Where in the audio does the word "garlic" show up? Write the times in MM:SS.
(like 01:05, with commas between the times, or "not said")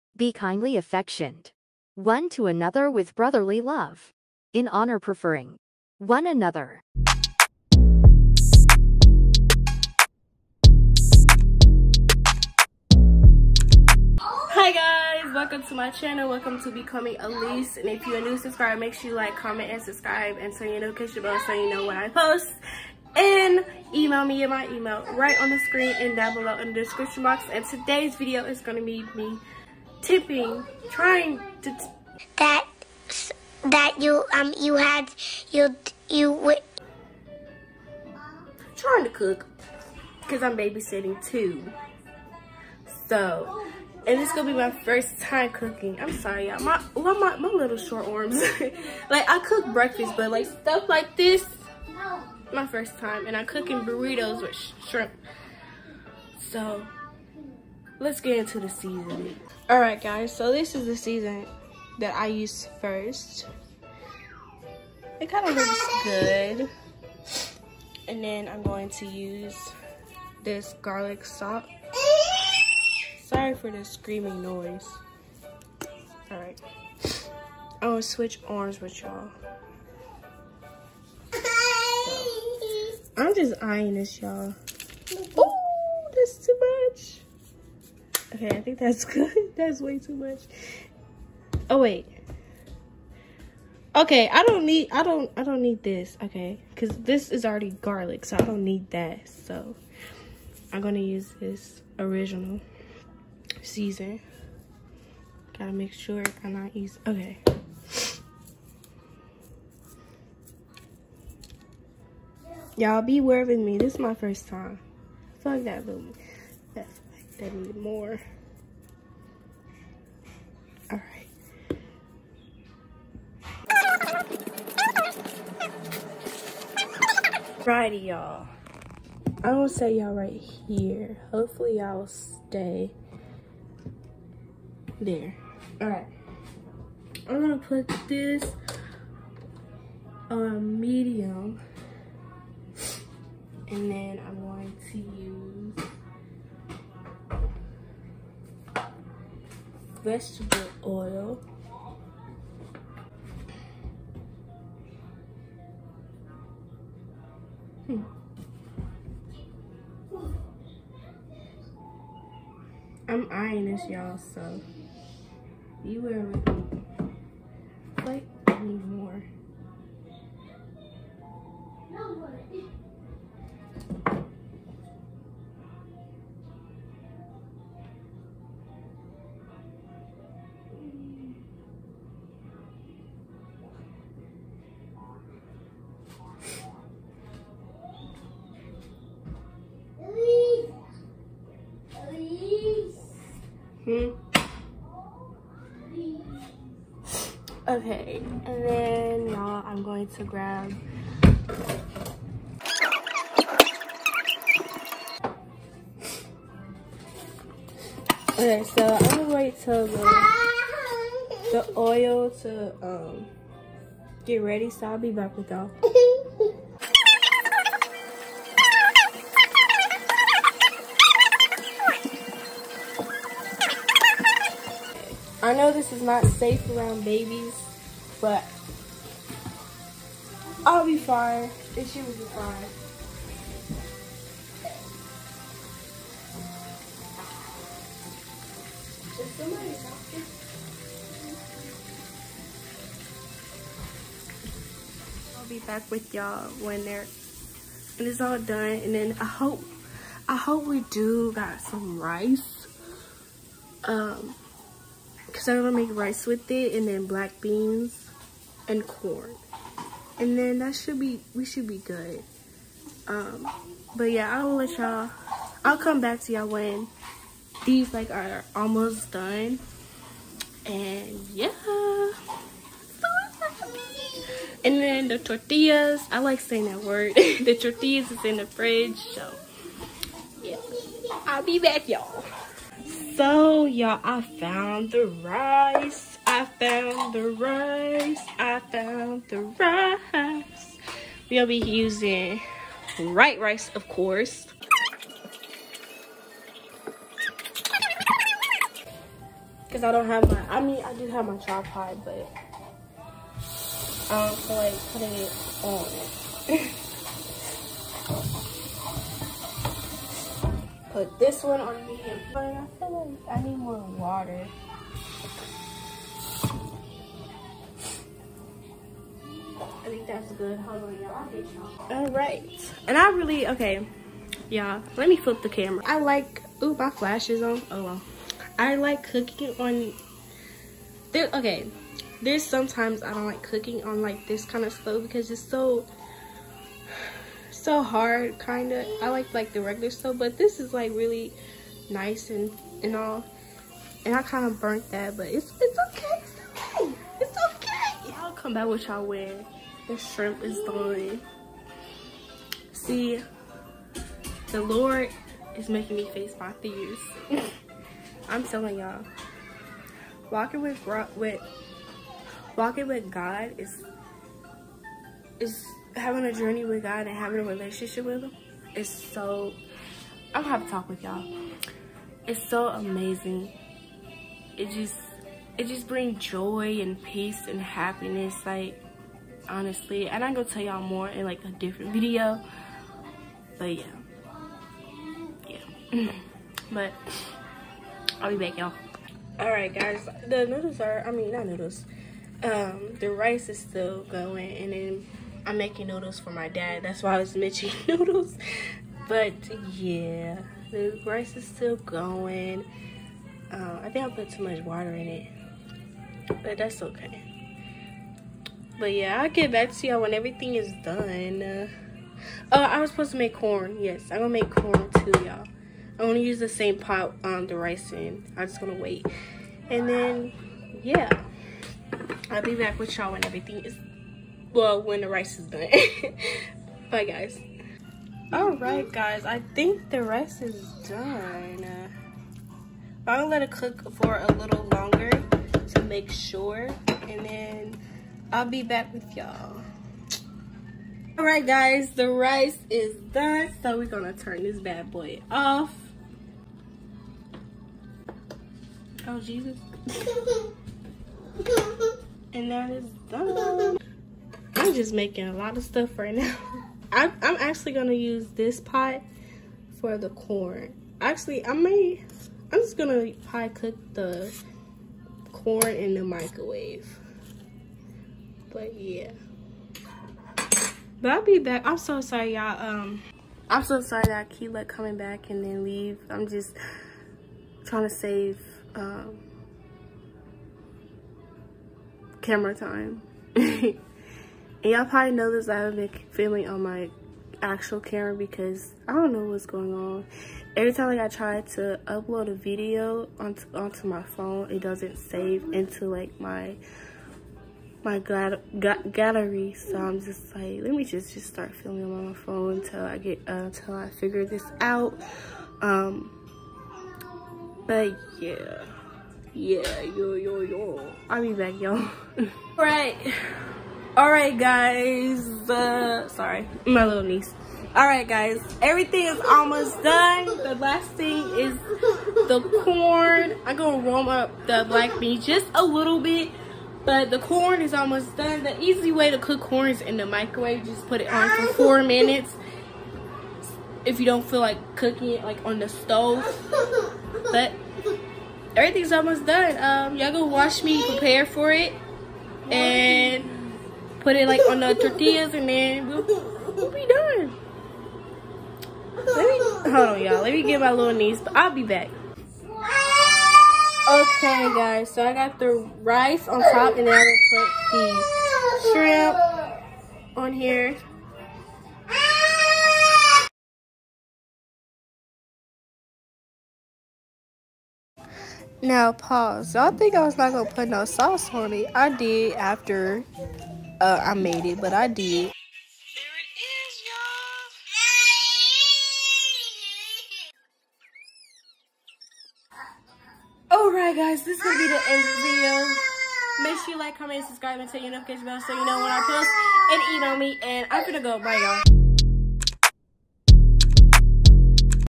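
01:10, 01:37.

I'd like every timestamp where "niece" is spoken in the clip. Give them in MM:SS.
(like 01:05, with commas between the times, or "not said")
08:37, 09:10.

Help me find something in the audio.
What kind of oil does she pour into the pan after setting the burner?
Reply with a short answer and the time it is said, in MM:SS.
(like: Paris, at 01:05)
vegetable oil, at 02:30.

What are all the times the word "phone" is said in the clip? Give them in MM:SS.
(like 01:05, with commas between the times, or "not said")
08:14, 08:22.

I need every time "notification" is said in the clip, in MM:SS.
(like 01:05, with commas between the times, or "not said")
00:20, 09:47.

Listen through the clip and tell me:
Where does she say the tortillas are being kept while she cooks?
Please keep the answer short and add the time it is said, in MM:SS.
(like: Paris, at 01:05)
the fridge, at 04:38.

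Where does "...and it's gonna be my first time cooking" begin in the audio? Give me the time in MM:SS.
00:44.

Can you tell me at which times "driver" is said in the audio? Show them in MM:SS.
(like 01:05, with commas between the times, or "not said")
not said.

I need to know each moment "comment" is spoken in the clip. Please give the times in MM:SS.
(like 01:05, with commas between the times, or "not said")
00:19, 09:46.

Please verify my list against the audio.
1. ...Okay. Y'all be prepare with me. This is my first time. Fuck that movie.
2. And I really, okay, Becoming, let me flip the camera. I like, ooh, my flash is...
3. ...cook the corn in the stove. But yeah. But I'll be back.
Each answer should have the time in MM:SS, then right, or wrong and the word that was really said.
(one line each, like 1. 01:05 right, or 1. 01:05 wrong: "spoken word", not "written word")
1. 01:47 wrong: "aware", not "prepare"
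2. 05:22 wrong: "Yeah", not "Becoming"
3. 07:43 wrong: "microwave", not "stove".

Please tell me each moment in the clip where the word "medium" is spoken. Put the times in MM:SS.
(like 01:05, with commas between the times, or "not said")
02:20, 05:11.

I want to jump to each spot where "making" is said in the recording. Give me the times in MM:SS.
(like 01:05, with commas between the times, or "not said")
05:55, 06:35, 07:34.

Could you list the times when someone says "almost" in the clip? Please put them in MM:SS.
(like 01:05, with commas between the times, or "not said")
04:28, 08:39, 08:47, 08:58.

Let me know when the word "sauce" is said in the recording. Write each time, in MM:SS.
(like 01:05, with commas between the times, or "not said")
09:30.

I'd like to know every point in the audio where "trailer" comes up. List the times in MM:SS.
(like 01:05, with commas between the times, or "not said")
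not said.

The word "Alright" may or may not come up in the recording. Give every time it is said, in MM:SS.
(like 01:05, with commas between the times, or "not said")
09:43.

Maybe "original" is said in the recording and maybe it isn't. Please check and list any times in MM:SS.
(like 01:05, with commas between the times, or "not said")
01:41.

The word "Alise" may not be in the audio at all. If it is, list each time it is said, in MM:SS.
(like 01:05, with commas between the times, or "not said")
00:17.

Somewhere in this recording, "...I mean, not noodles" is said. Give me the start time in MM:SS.
06:31.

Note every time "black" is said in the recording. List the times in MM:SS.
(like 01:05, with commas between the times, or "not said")
04:17, 08:44.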